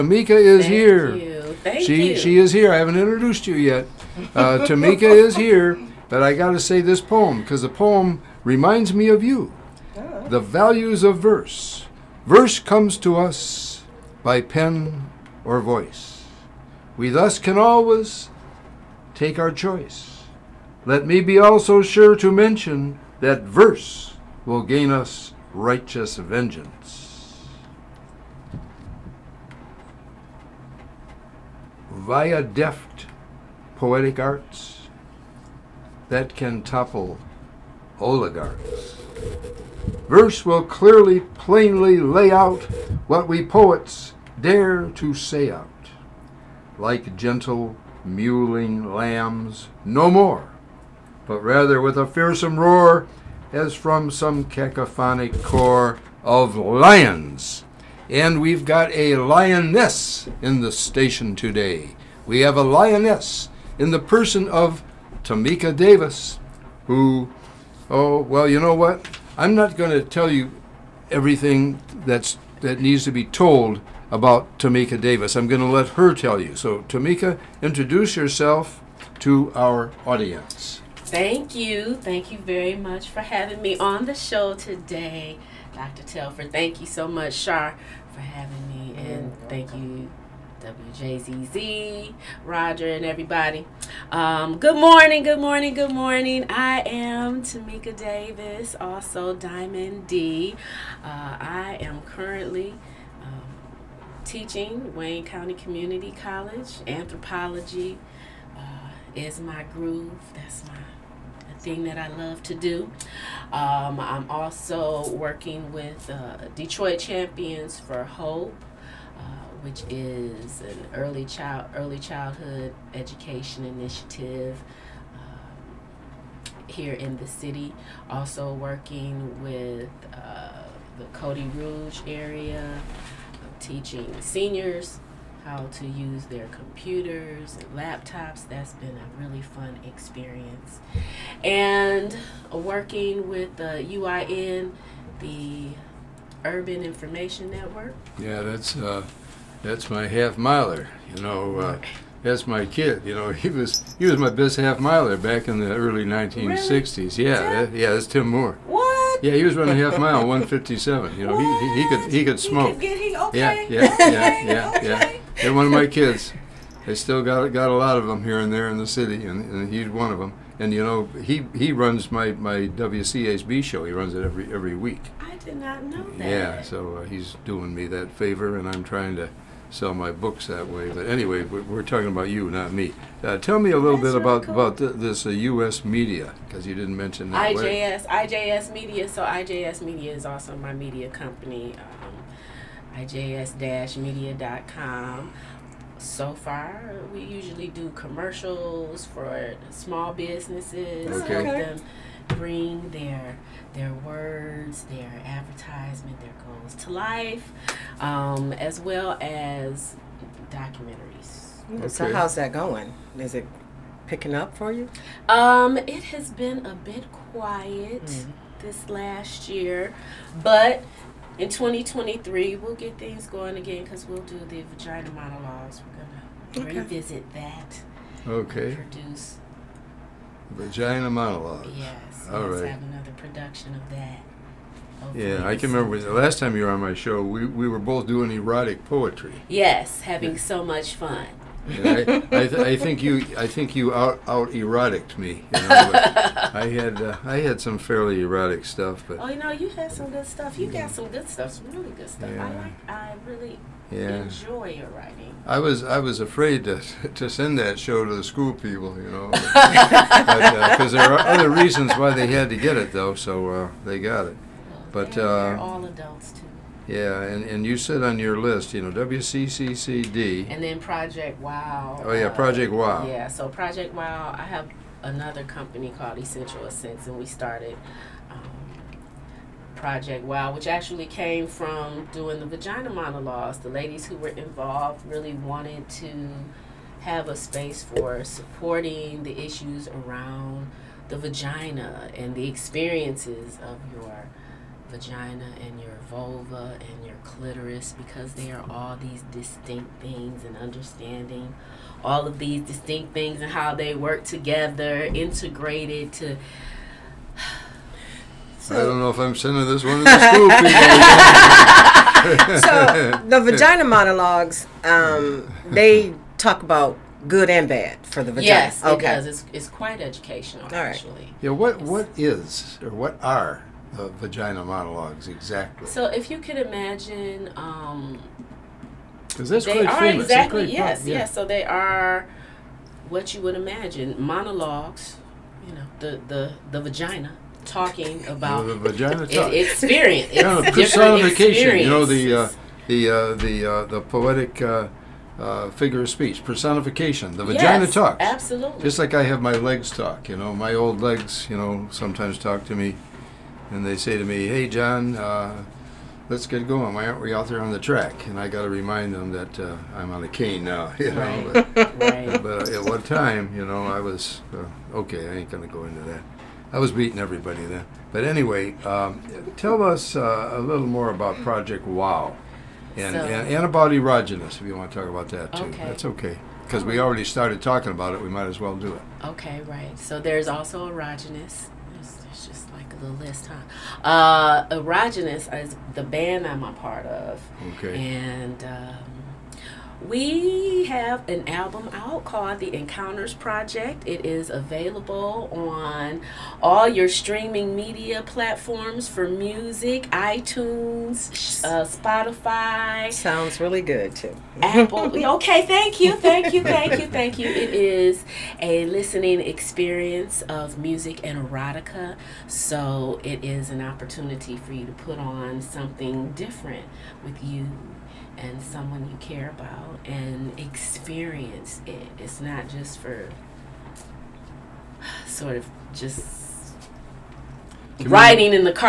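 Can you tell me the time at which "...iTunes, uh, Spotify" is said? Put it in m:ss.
6:40.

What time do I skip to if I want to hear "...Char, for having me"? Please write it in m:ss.
1:27.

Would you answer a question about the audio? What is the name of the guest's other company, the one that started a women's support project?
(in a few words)
Essential Ascents.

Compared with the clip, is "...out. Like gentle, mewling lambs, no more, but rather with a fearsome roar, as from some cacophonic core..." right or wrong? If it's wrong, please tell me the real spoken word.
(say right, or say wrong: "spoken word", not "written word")
right.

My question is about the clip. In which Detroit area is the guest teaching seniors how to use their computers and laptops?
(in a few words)
Cody Rouge.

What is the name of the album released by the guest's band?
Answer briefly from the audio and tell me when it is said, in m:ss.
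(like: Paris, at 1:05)
The Encounters Project, at 6:32.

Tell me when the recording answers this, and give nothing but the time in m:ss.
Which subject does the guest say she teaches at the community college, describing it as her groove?
1:46.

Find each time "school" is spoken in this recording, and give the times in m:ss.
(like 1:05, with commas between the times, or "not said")
4:18, 5:10.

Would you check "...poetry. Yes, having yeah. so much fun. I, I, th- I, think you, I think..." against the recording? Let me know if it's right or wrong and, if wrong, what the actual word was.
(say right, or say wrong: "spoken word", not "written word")
right.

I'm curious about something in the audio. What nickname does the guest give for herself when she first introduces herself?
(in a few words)
Diamond D.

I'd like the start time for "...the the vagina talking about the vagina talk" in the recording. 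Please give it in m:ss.
5:36.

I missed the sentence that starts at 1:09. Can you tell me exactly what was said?
I'm not going to tell you everything that's that needs to be told about Tamika Davis.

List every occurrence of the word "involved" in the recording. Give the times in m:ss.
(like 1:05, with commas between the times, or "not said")
4:44.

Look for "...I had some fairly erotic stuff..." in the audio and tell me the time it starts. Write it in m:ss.
4:07.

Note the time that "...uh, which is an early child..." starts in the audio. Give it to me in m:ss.
1:59.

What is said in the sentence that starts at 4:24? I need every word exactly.
Well, but uh, they're all adults too.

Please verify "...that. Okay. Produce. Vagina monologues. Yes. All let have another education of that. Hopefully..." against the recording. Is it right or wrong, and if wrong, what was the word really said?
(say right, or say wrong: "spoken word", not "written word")
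wrong: "production", not "education".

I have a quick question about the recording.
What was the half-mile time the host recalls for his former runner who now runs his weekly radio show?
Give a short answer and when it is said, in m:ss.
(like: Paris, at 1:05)
1:57, at 2:40.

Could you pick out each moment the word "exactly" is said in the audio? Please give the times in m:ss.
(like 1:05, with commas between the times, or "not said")
5:25, 5:30.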